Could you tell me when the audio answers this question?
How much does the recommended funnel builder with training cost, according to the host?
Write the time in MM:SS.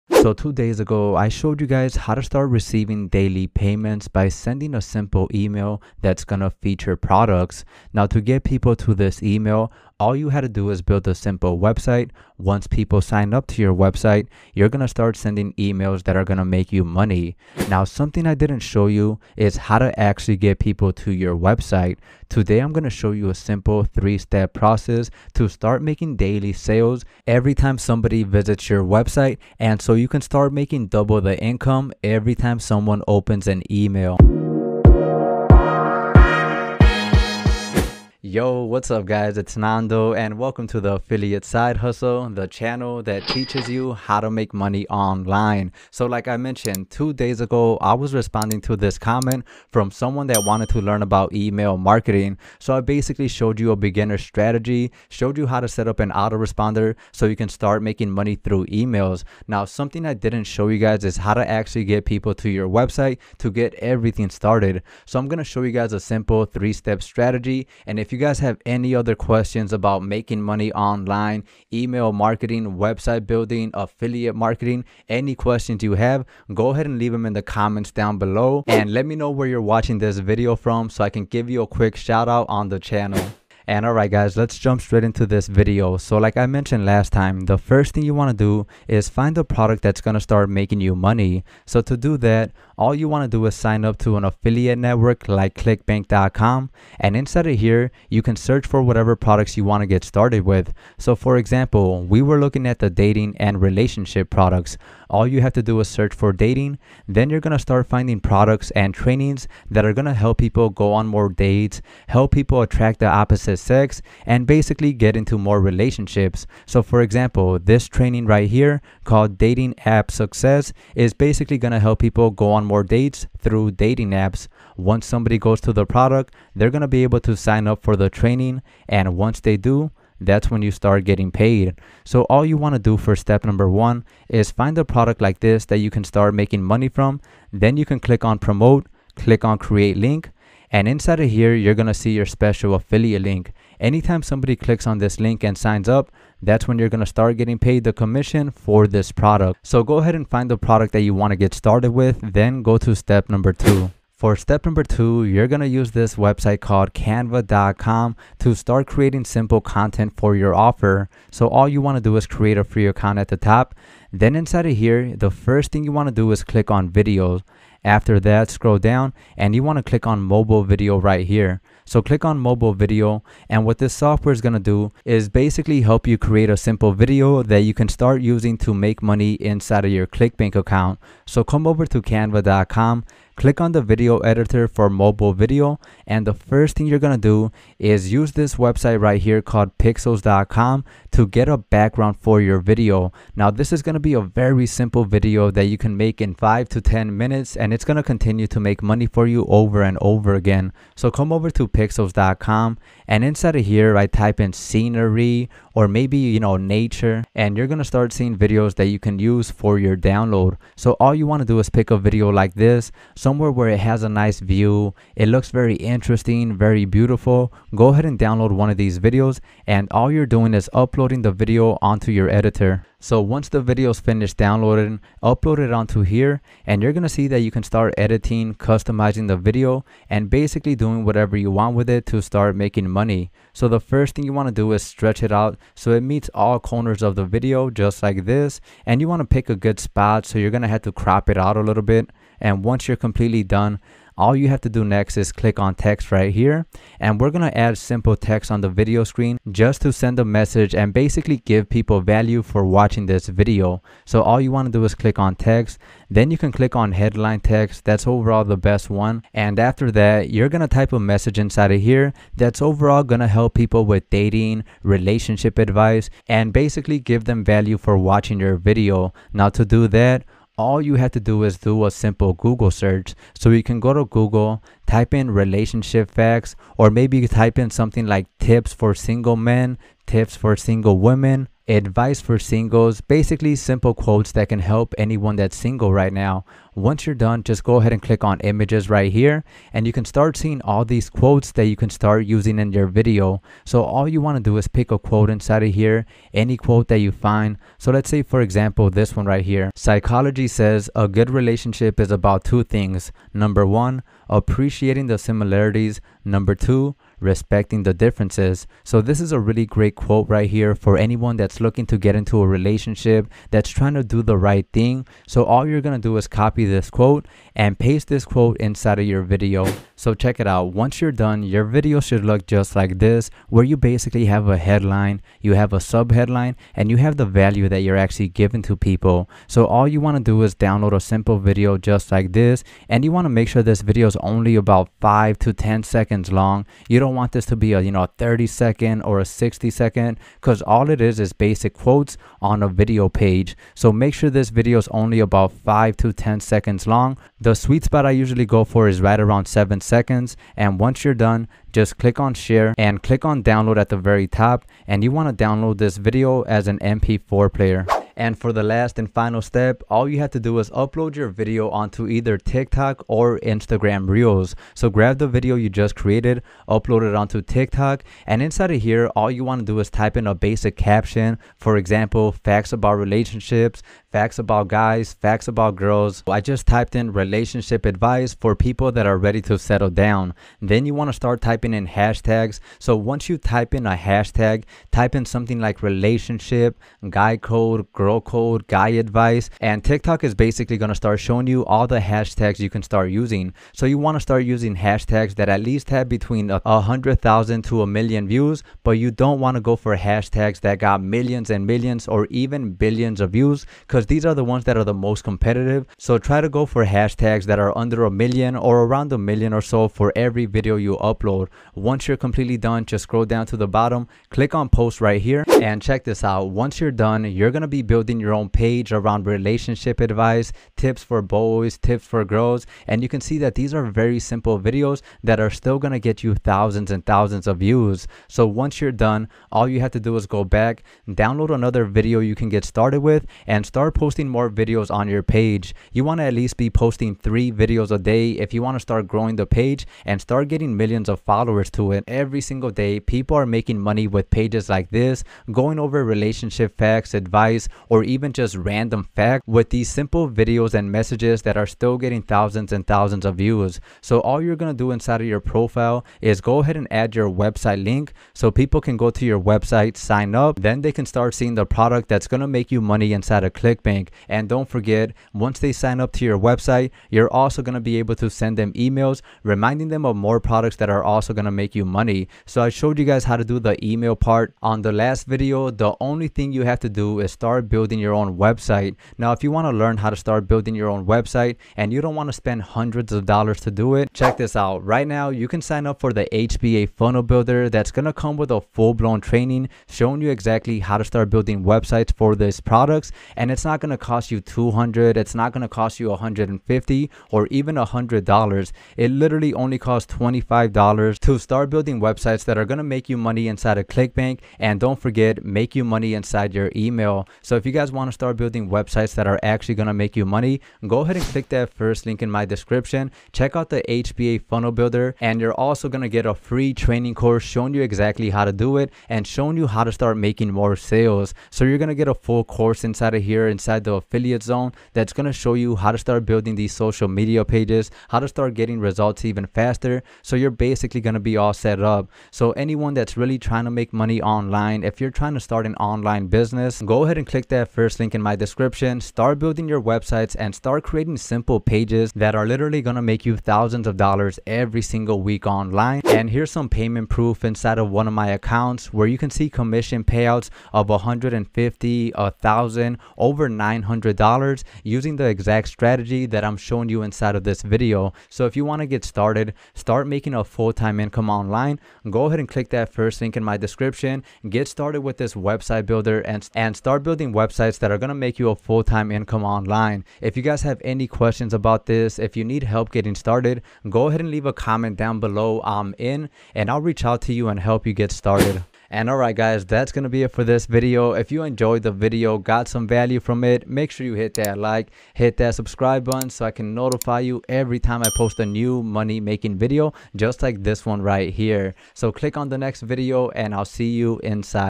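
08:20.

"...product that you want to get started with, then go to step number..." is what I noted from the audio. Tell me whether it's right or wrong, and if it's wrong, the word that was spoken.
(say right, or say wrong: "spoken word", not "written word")
right.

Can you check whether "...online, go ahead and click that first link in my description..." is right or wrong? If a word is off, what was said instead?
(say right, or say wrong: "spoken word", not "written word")
right.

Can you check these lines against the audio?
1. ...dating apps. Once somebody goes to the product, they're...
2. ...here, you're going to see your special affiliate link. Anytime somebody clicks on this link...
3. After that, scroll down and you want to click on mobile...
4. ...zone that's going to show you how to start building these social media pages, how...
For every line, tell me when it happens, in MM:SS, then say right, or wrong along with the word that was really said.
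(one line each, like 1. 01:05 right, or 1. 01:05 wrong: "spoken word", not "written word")
1. 02:03 right
2. 02:21 right
3. 02:47 right
4. 08:44 right.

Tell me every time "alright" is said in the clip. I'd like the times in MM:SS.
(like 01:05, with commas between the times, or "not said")
01:23, 09:39.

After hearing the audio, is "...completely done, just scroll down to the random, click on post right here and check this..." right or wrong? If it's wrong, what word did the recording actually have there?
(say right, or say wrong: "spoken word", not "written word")
wrong: "bottom", not "random".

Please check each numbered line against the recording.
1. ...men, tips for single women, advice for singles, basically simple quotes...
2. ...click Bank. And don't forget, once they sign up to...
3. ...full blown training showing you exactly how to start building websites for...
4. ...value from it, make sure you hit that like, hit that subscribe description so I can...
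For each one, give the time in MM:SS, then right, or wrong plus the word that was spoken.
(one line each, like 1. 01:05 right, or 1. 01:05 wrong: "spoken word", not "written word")
1. 04:39 right
2. 07:43 right
3. 08:08 right
4. 09:42 wrong: "button", not "description".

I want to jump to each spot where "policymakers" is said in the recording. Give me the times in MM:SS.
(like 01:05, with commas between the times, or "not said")
not said.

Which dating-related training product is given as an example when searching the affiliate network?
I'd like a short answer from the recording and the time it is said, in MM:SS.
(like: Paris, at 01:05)
Dating App Success, at 01:59.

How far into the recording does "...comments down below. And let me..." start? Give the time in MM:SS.
01:17.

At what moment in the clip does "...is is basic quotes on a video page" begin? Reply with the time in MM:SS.
05:41.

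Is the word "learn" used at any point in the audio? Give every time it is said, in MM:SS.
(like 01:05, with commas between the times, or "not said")
00:50, 07:59.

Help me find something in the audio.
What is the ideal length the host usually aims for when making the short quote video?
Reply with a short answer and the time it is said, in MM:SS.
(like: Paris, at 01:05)
7 seconds, at 05:49.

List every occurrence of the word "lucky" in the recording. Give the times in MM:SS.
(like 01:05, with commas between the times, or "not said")
not said.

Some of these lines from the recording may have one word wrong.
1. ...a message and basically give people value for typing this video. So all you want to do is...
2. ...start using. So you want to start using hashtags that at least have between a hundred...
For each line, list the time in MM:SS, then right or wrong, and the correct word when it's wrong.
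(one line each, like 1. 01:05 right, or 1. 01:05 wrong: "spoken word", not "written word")
1. 04:10 wrong: "watching", not "typing"
2. 06:32 right.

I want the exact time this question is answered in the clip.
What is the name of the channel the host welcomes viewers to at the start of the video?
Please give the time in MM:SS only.
00:40.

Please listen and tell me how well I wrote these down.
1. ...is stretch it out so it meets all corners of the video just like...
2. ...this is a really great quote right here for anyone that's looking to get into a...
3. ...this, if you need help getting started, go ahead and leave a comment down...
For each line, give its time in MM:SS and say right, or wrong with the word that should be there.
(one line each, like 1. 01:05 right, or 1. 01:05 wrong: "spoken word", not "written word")
1. 03:54 right
2. 05:08 right
3. 09:31 right.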